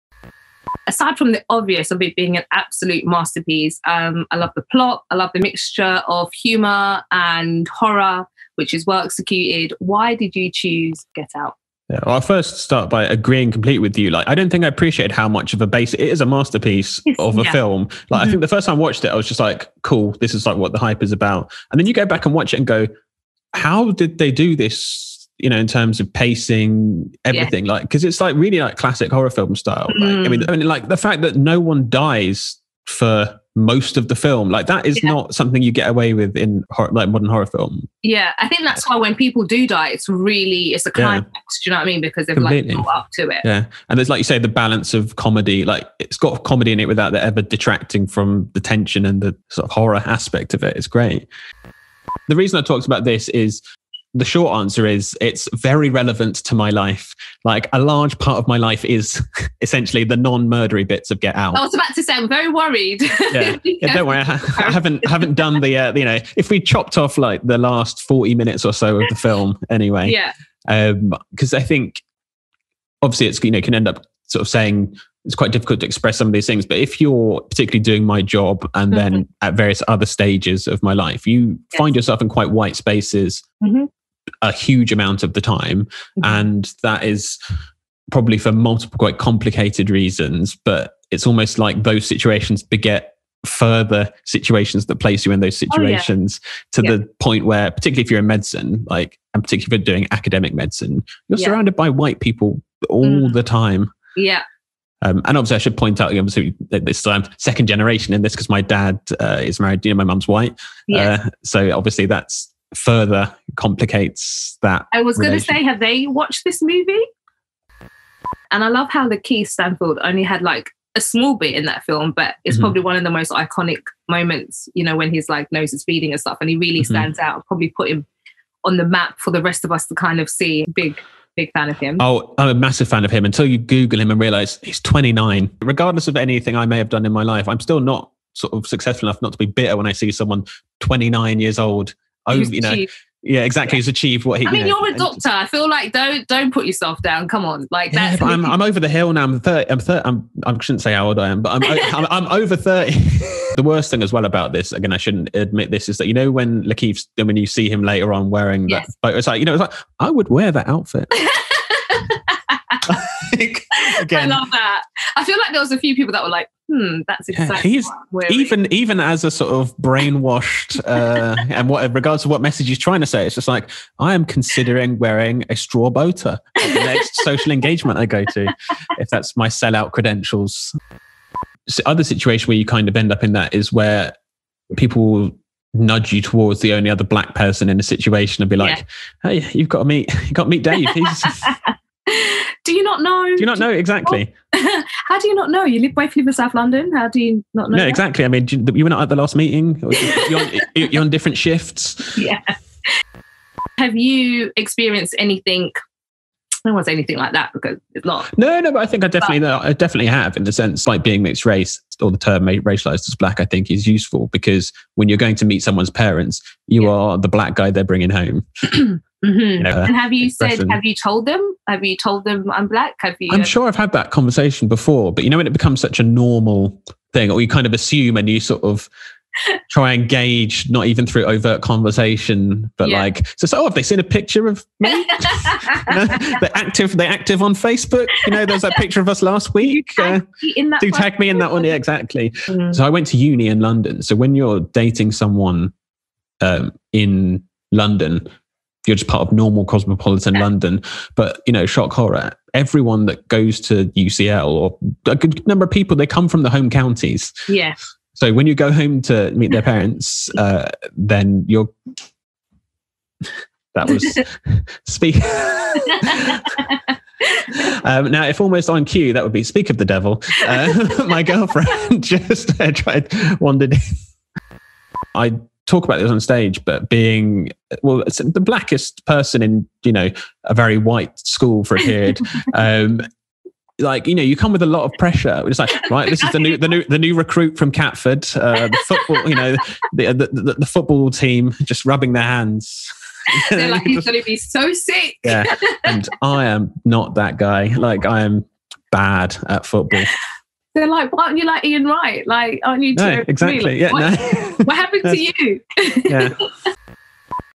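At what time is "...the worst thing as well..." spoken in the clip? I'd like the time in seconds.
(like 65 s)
153 s.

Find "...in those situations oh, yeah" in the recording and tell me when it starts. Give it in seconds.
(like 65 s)
95 s.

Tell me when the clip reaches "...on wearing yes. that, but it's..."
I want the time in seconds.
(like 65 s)
158 s.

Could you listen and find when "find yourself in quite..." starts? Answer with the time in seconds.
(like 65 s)
81 s.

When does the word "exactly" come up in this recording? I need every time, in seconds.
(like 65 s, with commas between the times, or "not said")
143 s, 167 s, 193 s, 197 s, 241 s, 303 s.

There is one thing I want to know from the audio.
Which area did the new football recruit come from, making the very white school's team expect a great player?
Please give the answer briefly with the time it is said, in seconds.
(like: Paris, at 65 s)
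Catford, at 287 s.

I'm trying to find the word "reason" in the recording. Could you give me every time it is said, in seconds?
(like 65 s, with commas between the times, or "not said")
52 s, 89 s.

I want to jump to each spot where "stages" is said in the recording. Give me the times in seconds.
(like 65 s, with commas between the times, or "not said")
80 s, 276 s.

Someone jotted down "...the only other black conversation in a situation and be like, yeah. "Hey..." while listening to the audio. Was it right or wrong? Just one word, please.
wrong.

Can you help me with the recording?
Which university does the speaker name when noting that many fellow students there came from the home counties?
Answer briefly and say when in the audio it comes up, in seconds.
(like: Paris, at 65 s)
UCL, at 253 s.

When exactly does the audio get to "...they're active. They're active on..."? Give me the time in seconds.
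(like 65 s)
236 s.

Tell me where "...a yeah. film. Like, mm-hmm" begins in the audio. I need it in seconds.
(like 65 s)
17 s.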